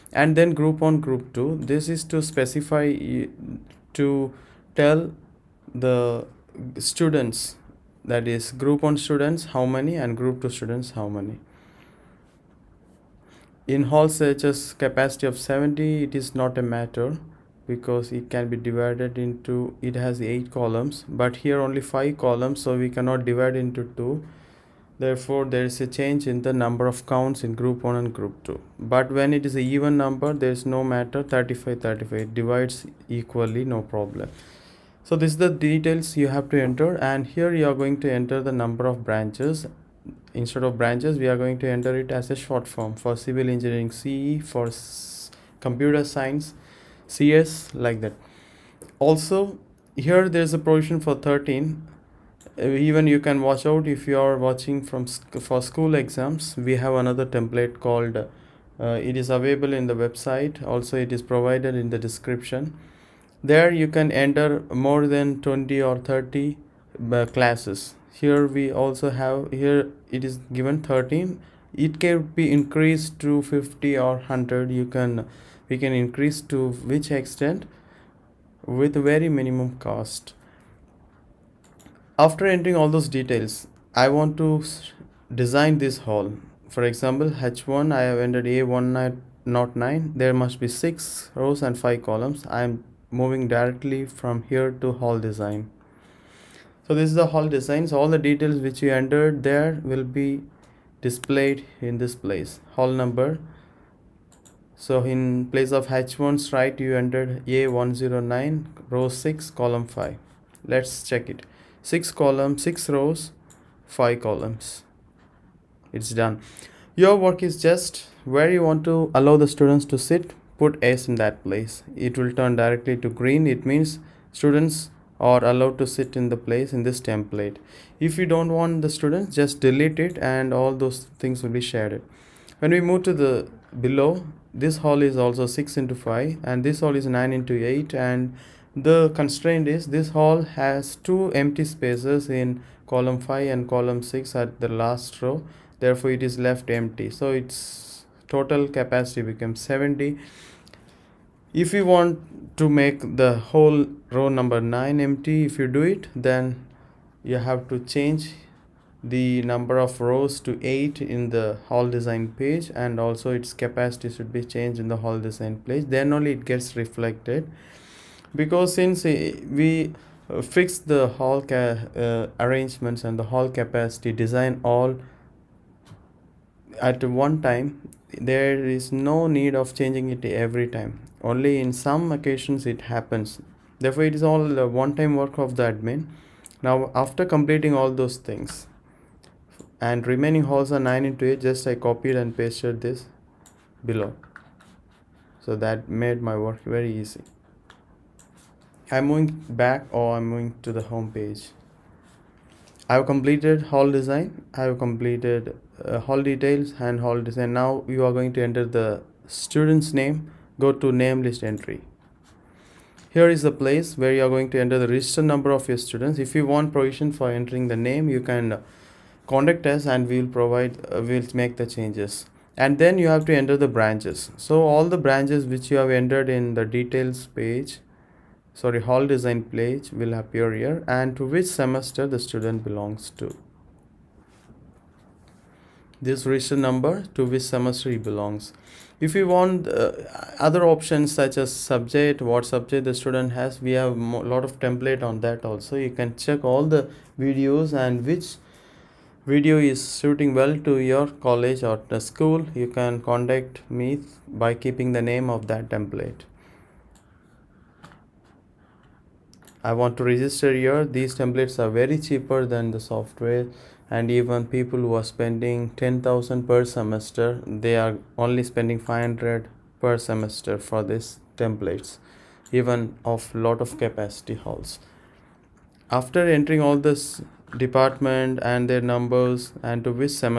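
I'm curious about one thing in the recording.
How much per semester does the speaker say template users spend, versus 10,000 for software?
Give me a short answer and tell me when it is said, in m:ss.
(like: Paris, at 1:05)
500, at 4:28.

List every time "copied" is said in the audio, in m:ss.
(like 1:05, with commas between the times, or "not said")
3:11.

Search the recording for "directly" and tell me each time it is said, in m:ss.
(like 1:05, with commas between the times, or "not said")
1:33, 2:02.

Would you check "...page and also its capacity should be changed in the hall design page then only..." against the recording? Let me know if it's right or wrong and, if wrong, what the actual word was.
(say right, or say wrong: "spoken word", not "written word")
right.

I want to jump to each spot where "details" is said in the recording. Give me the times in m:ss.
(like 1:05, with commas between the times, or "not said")
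0:35, 1:23, 1:38, 3:26, 3:46.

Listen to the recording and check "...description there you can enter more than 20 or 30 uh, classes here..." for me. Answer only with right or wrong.
right.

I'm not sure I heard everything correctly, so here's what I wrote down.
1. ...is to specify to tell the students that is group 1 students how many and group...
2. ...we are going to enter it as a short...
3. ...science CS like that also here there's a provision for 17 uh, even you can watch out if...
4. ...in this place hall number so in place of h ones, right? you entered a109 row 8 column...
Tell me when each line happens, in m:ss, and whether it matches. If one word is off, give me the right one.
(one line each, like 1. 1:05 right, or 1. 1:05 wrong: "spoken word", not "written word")
1. 0:01 right
2. 0:41 right
3. 0:46 wrong: "13", not "17"
4. 1:41 wrong: "6", not "8".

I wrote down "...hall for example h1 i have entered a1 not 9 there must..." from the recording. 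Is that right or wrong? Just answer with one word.
right.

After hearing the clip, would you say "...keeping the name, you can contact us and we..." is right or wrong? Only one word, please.
wrong.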